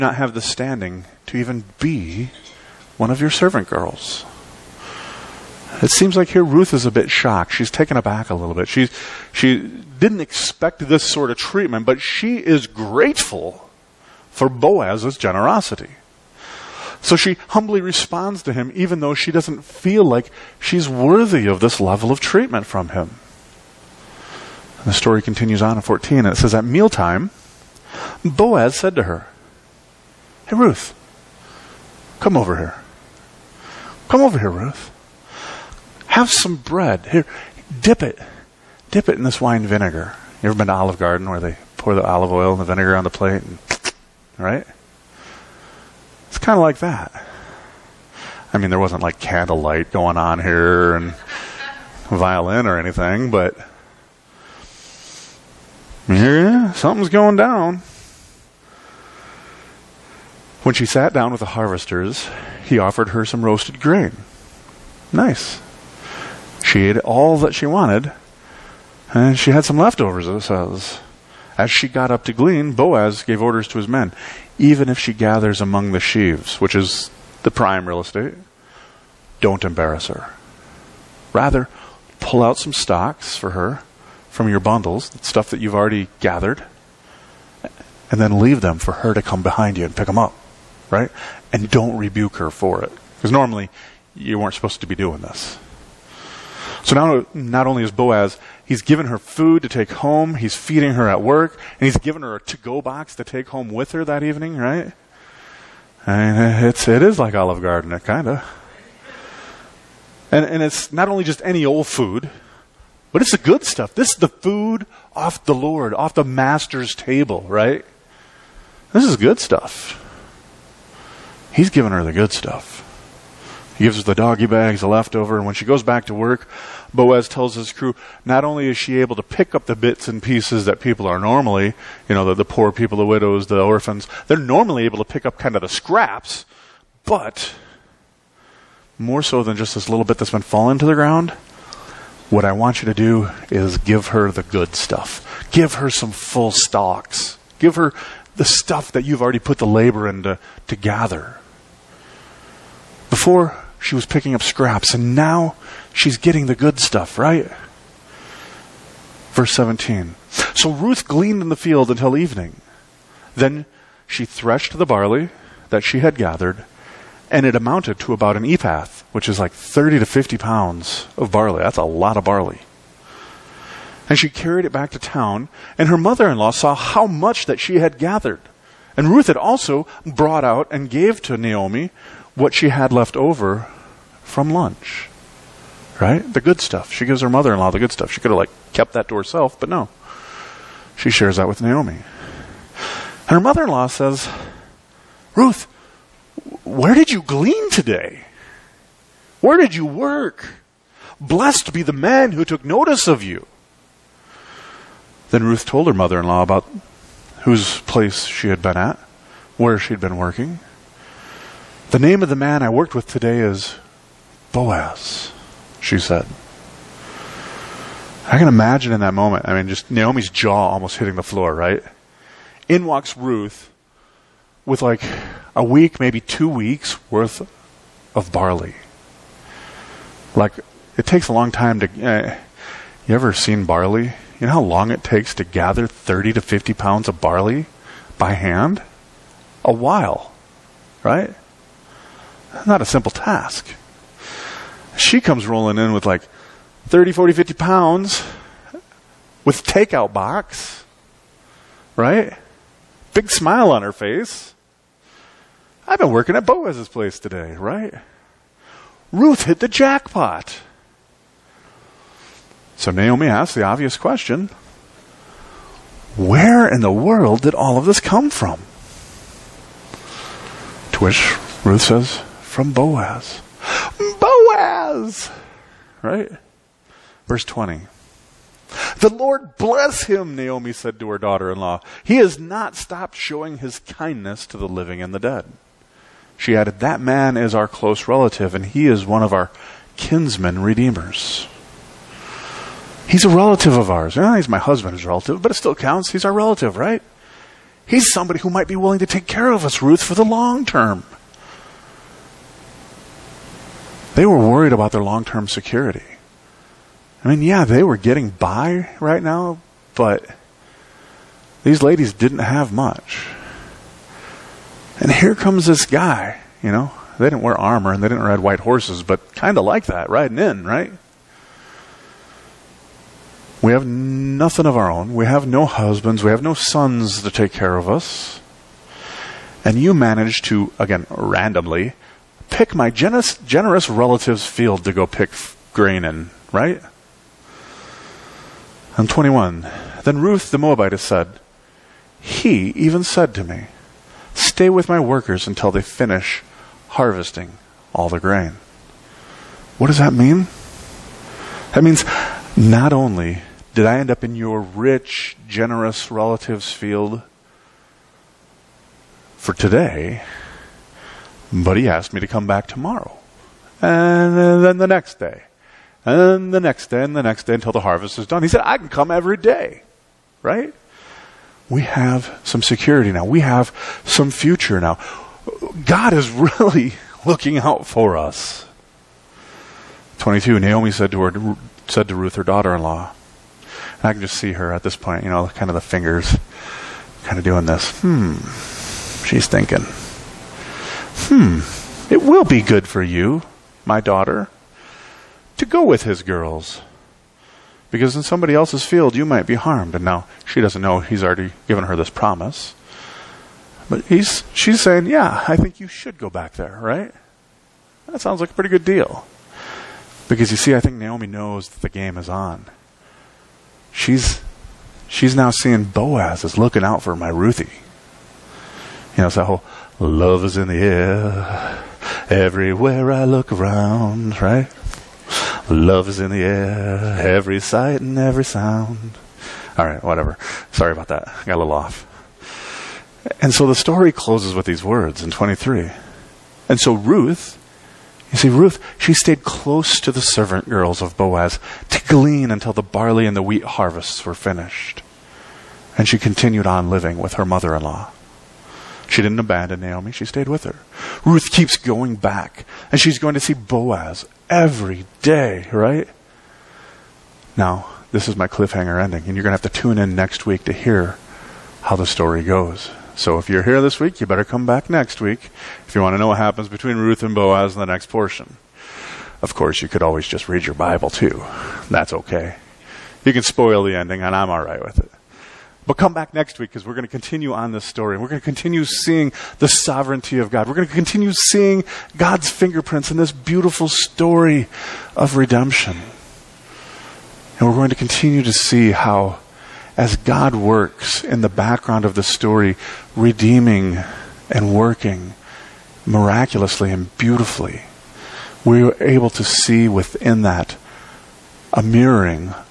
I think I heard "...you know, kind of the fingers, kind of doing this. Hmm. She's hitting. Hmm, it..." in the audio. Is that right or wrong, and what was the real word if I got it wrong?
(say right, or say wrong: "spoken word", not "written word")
wrong: "thinking", not "hitting".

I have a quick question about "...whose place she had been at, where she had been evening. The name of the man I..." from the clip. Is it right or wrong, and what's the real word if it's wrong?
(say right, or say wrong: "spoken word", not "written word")
wrong: "working", not "evening".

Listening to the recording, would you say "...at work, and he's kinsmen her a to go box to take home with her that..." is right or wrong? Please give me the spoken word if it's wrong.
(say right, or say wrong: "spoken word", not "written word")
wrong: "given", not "kinsmen".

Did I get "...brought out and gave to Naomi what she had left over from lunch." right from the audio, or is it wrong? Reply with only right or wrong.
right.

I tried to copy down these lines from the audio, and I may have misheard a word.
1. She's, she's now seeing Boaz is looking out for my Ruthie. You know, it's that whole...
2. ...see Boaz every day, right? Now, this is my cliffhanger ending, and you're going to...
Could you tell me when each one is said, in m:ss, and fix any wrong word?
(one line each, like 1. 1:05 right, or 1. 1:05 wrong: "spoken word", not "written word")
1. 6:53 right
2. 7:33 right.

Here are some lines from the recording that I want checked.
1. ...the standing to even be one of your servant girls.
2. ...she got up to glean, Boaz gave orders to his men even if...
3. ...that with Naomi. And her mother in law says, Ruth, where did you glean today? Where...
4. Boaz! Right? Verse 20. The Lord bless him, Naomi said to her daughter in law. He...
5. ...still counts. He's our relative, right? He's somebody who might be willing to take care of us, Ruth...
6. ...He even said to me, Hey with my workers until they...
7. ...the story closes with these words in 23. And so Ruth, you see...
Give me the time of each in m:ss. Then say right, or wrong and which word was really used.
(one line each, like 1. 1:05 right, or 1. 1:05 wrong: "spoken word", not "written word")
1. 0:00 right
2. 1:11 right
3. 3:11 right
4. 4:34 right
5. 4:55 right
6. 5:42 wrong: "Stay", not "Hey"
7. 7:13 right.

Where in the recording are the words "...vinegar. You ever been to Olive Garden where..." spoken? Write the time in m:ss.
0:39.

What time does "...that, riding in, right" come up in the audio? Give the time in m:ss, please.
5:19.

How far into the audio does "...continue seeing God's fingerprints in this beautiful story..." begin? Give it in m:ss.
8:00.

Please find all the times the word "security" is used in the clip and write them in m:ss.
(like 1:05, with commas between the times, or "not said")
5:05, 6:12.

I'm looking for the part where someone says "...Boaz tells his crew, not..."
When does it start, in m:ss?
2:06.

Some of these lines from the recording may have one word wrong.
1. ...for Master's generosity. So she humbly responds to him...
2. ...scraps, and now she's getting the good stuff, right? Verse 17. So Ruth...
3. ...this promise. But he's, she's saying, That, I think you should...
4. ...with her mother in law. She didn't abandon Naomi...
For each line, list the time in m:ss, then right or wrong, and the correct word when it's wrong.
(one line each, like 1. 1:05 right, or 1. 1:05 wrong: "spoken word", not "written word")
1. 0:14 wrong: "Boaz", not "Master"
2. 2:34 right
3. 6:41 wrong: "Yeah", not "That"
4. 7:27 right.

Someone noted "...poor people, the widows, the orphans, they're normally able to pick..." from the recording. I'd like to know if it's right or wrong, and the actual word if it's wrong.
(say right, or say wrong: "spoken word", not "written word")
right.